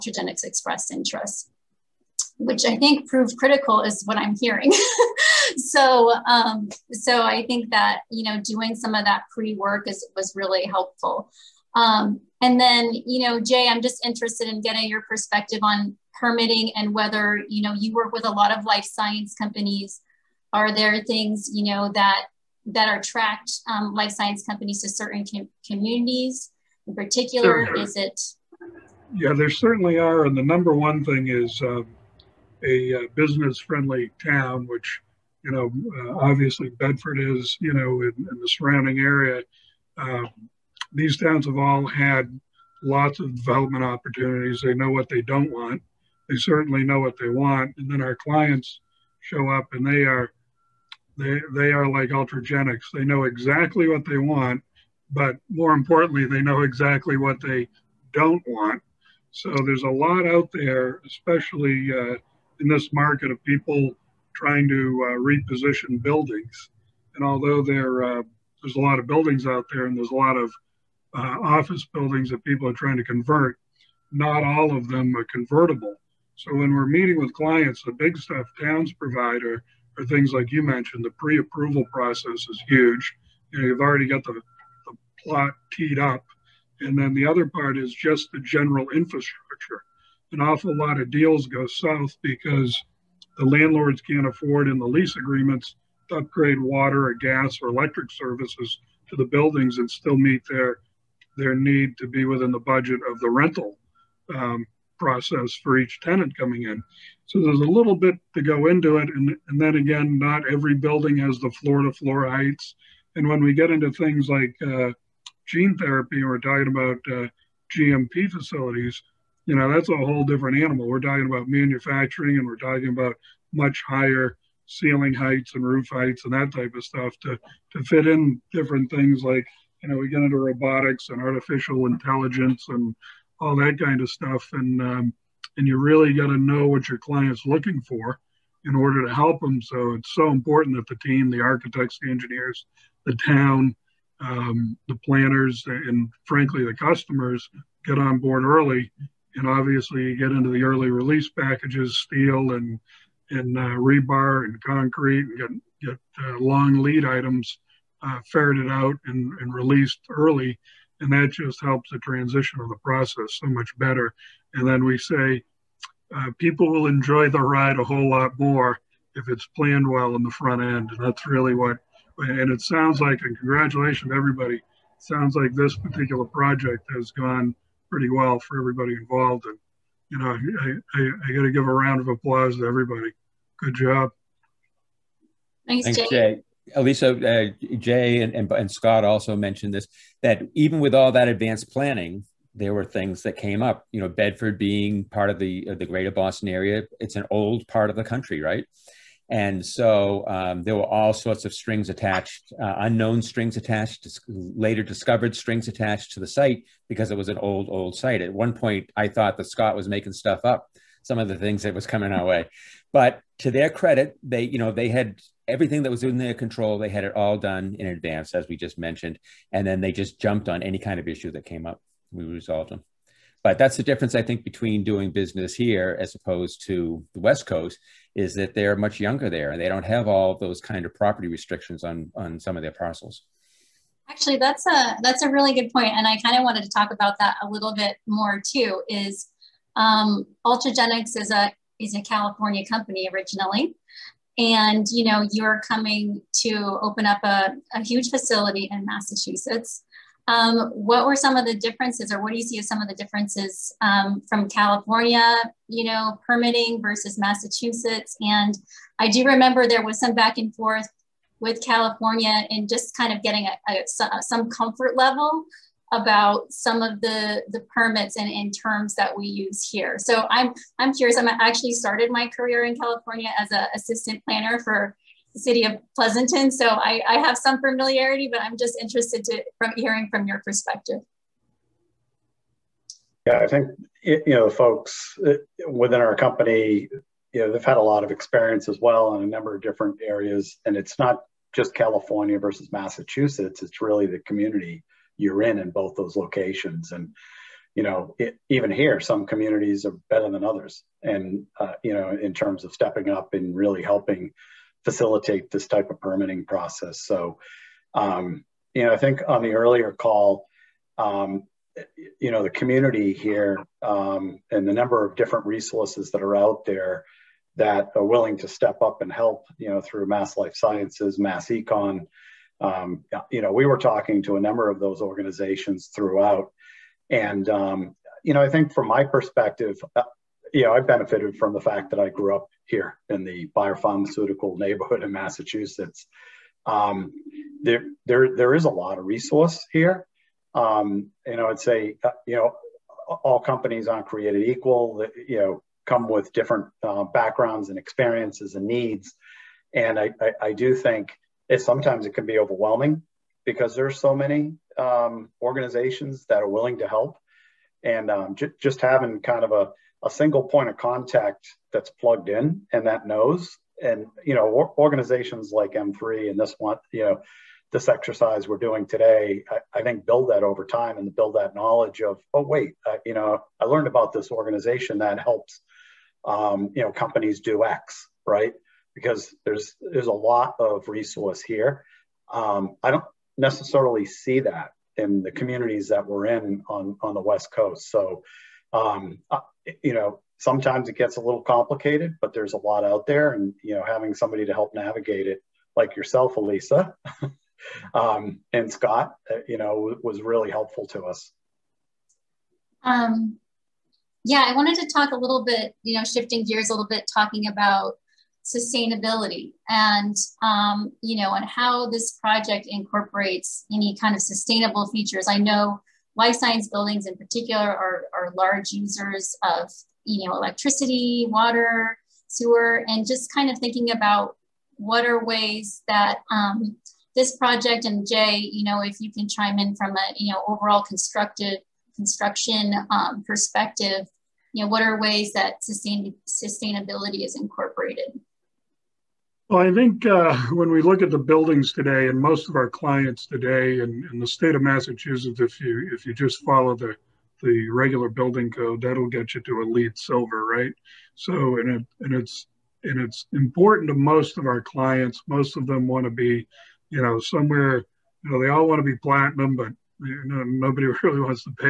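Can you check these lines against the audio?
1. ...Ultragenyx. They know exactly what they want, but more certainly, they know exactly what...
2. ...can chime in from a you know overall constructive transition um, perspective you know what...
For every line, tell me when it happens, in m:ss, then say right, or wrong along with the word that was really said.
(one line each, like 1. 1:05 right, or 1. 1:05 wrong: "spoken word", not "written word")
1. 0:52 wrong: "importantly", not "certainly"
2. 7:09 wrong: "construction", not "transition".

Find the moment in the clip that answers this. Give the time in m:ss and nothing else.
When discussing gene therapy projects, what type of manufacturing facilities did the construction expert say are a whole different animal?
1:57.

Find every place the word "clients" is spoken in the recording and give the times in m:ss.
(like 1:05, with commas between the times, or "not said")
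0:48, 1:17, 2:16, 7:22, 7:34.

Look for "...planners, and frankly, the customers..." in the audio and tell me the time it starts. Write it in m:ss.
2:25.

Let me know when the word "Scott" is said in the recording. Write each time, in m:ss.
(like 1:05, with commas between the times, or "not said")
3:08, 3:29, 6:38.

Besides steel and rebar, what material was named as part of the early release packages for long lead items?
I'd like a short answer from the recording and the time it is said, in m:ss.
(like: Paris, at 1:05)
concrete, at 2:34.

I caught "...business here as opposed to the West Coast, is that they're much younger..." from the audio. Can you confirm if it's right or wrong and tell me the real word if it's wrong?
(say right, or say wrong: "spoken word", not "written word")
right.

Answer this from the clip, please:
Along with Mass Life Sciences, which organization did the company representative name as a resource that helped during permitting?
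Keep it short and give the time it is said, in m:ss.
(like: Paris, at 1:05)
MassEcon, at 5:21.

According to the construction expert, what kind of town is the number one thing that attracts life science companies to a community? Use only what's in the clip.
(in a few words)
business friendly town.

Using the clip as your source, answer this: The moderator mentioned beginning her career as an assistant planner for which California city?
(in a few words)
Pleasanton.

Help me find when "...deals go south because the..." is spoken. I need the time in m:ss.
1:31.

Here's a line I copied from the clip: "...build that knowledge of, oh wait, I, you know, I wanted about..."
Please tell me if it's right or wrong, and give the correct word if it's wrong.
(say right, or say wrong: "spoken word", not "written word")
wrong: "learned", not "wanted".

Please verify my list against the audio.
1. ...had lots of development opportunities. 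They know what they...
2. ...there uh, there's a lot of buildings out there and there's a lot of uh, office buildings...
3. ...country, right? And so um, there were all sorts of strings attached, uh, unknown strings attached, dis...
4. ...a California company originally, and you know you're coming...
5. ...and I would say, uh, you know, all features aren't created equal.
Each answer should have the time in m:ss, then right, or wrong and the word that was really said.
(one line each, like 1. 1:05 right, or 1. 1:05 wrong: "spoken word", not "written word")
1. 0:41 right
2. 1:07 right
3. 3:18 right
4. 4:01 right
5. 5:41 wrong: "companies", not "features".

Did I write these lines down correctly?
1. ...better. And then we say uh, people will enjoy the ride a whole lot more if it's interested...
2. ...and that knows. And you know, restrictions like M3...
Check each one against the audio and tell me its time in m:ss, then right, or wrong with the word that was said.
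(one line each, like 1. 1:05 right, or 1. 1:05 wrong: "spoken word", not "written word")
1. 2:43 wrong: "planned", not "interested"
2. 6:02 wrong: "organizations", not "restrictions".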